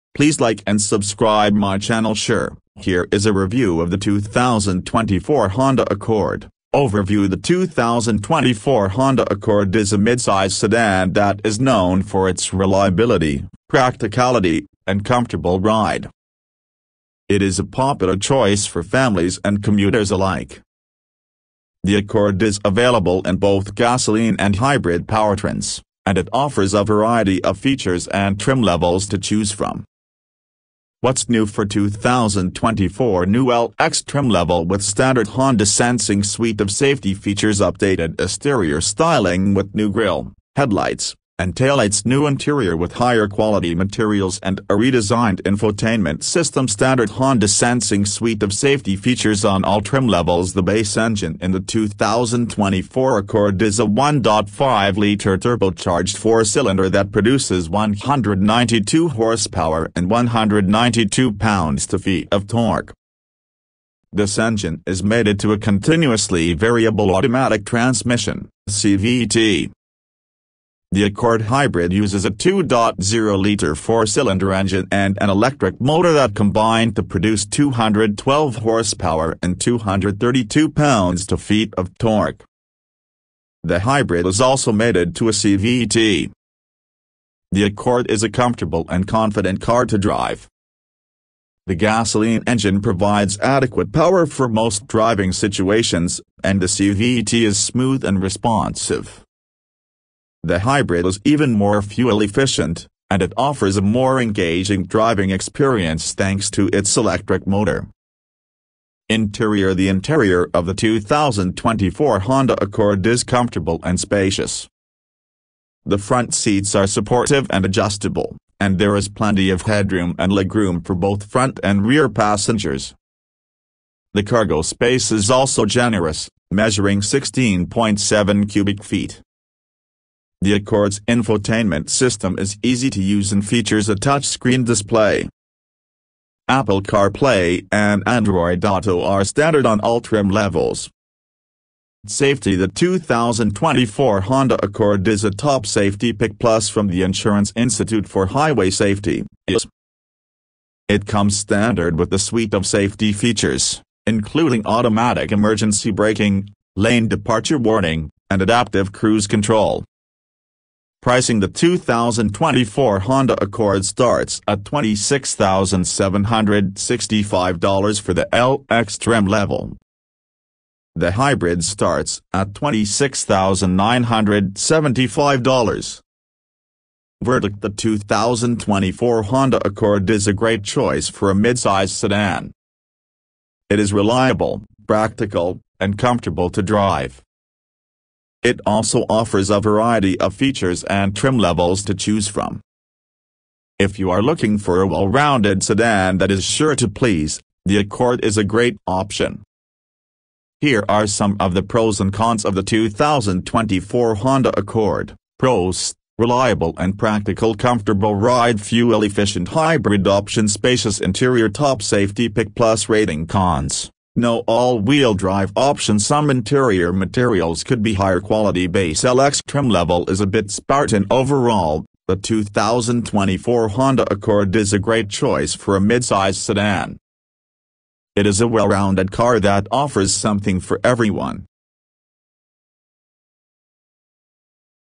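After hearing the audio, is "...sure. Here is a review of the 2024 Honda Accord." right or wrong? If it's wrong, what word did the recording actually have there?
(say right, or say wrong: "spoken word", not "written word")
right.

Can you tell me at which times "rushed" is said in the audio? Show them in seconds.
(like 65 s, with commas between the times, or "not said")
not said.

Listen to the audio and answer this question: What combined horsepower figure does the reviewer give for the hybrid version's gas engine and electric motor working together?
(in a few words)
212.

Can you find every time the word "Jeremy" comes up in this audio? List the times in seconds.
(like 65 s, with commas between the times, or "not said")
not said.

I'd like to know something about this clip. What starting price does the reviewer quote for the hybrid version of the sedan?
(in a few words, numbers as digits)
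$26,975.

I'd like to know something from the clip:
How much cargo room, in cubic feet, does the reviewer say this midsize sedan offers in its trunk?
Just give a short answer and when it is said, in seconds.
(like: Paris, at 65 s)
16.7, at 127 s.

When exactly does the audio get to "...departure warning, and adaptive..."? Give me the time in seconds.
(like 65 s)
157 s.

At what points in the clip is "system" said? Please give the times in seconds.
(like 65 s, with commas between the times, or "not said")
46 s, 131 s.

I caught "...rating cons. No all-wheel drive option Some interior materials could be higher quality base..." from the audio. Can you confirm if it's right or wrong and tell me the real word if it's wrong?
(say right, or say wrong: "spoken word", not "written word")
right.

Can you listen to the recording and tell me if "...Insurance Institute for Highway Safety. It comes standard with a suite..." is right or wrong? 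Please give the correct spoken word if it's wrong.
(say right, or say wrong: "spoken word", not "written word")
right.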